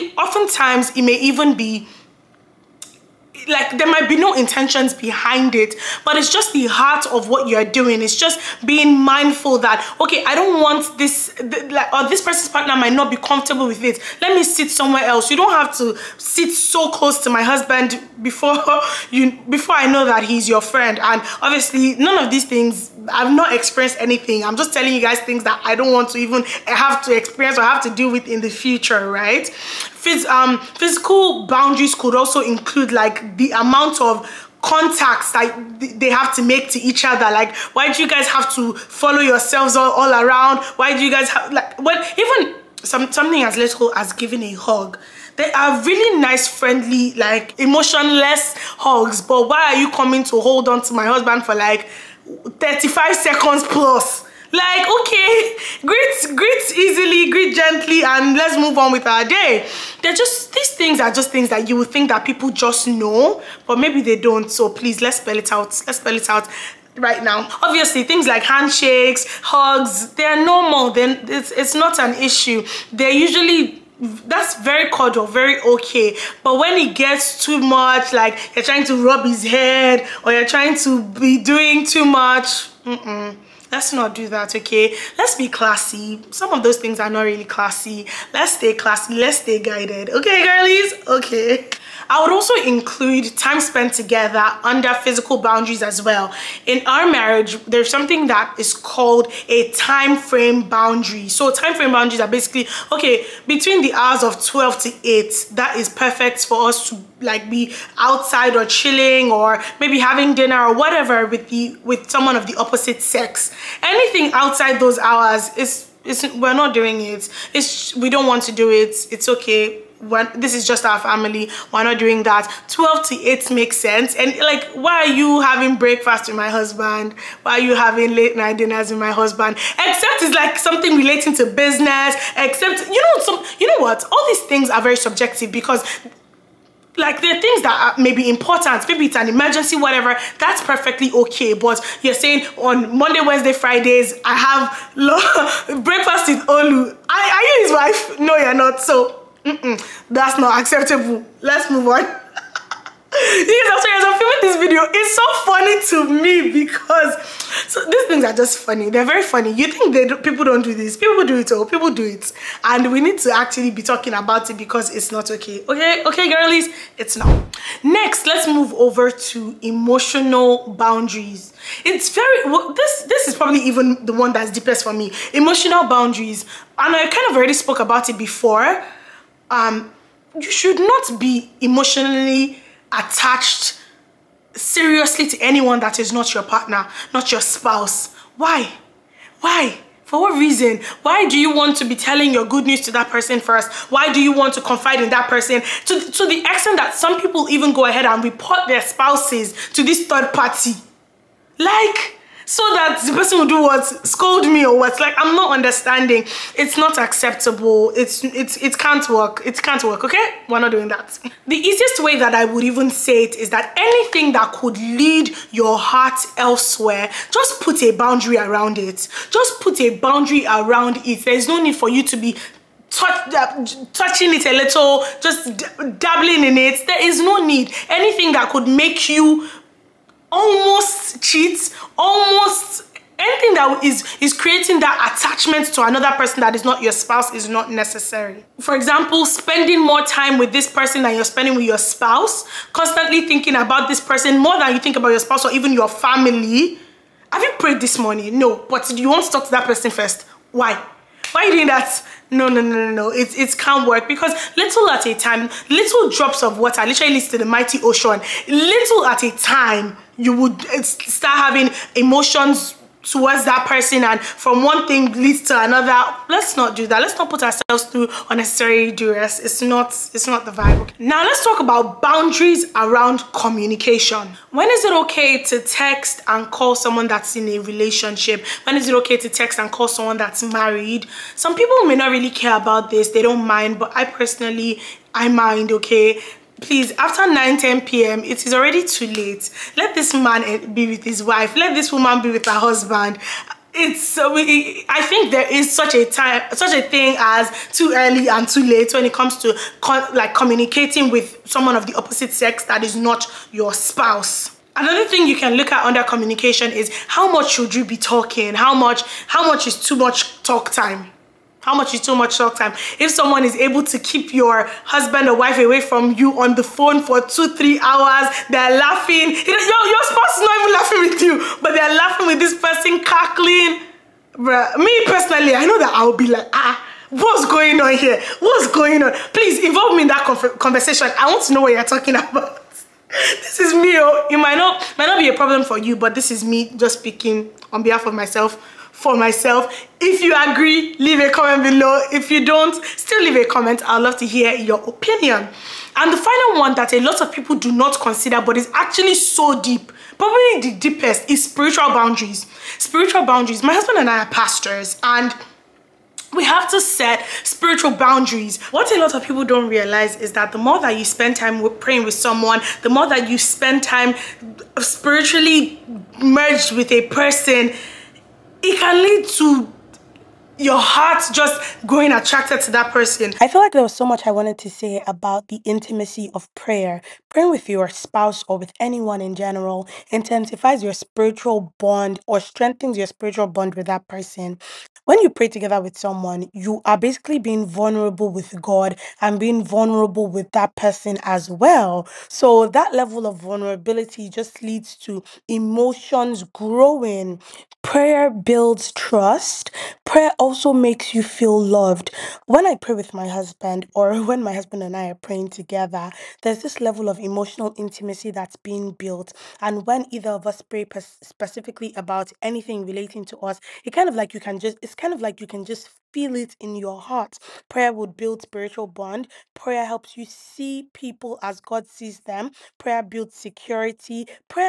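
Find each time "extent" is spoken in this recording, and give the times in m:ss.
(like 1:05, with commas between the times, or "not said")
3:16.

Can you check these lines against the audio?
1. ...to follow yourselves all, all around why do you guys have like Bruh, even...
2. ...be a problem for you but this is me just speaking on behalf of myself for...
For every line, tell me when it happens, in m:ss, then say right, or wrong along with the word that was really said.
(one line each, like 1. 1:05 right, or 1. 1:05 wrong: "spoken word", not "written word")
1. 0:38 wrong: "Well", not "Bruh"
2. 5:35 right.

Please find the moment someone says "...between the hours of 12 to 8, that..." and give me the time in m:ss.
1:43.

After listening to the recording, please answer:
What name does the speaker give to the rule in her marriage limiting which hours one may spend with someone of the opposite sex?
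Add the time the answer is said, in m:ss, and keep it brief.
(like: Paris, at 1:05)
time frame boundary, at 1:39.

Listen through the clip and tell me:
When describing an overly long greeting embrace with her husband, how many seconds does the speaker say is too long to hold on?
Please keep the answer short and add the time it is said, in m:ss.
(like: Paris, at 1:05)
35 seconds, at 0:52.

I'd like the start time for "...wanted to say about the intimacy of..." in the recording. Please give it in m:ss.
6:14.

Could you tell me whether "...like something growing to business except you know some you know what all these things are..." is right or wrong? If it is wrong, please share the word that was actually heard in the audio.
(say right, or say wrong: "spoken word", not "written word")
wrong: "relating", not "growing".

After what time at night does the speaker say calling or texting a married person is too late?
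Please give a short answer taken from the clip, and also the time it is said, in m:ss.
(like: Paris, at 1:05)
9 10 p.m., at 4:47.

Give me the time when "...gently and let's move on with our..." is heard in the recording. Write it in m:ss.
0:57.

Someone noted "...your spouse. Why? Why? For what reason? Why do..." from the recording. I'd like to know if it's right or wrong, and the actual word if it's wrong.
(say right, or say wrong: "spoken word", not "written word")
right.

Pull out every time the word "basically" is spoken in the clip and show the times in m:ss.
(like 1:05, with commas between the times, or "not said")
1:42, 6:26.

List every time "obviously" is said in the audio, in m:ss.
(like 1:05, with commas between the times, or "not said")
0:21, 1:07.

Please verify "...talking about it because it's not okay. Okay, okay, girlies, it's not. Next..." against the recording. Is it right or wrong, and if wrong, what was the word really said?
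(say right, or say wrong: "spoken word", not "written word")
right.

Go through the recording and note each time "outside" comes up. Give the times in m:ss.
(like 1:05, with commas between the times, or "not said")
1:47, 1:54.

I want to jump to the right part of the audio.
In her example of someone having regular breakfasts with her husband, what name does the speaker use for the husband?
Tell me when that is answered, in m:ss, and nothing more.
2:26.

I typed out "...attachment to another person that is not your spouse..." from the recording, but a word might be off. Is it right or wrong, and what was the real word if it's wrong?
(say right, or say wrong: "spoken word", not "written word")
right.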